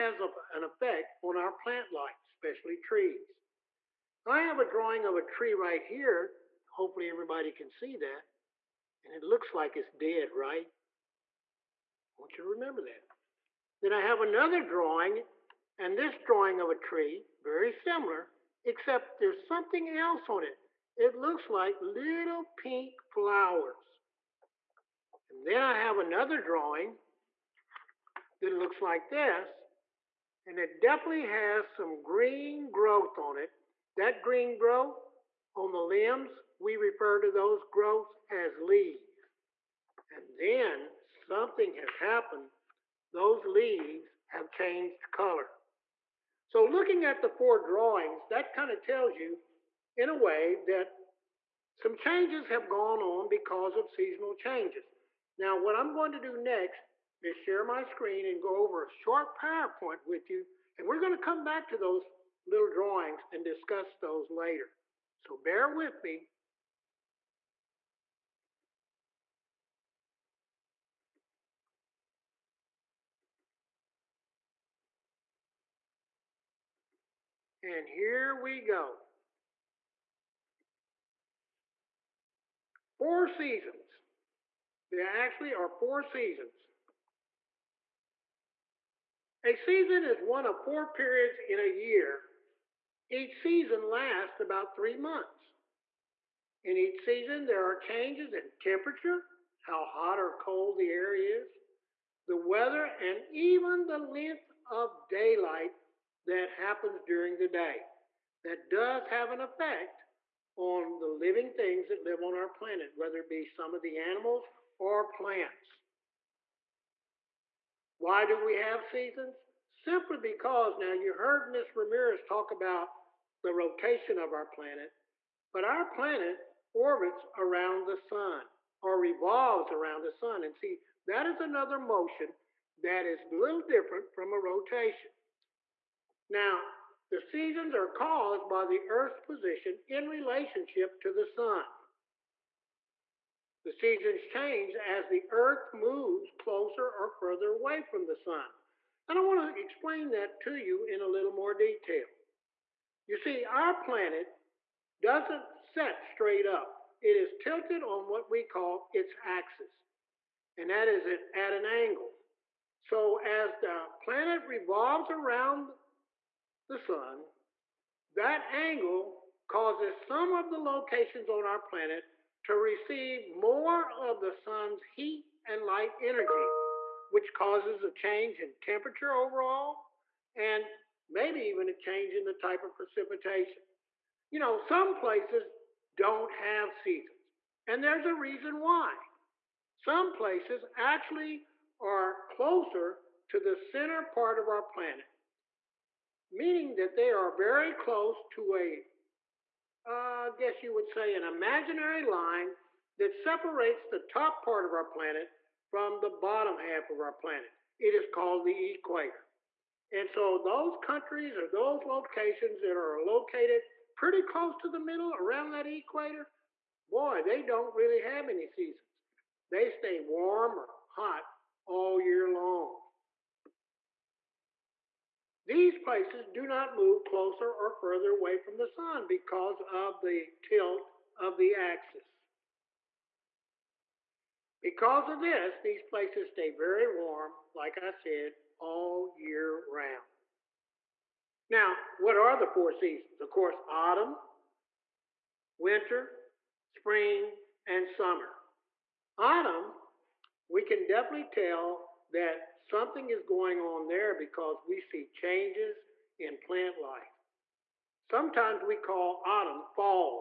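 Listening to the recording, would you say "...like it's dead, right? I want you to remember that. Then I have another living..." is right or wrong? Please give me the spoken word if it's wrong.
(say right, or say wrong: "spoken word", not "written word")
wrong: "drawing", not "living".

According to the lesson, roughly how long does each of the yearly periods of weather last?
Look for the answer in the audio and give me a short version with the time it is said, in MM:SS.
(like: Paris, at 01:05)
3 months, at 01:34.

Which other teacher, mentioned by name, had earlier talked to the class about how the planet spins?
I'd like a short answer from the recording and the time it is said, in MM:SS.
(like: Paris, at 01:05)
Ms. Ramirez, at 02:01.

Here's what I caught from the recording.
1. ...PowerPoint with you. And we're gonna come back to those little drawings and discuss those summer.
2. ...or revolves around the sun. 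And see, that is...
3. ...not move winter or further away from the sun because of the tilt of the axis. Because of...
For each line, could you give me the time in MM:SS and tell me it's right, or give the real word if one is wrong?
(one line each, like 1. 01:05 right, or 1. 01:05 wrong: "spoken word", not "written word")
1. 00:59 wrong: "later", not "summer"
2. 02:08 right
3. 03:46 wrong: "closer", not "winter".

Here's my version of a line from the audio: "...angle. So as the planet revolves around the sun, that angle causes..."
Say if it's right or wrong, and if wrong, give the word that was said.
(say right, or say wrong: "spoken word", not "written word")
right.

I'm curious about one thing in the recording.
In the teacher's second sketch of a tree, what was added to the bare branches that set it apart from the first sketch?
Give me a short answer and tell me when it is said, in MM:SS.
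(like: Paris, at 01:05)
little pink flowers, at 00:21.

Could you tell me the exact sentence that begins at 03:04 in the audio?
You know, some places don't have seasons, and there's a reason why.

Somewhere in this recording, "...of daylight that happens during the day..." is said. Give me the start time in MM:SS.
01:44.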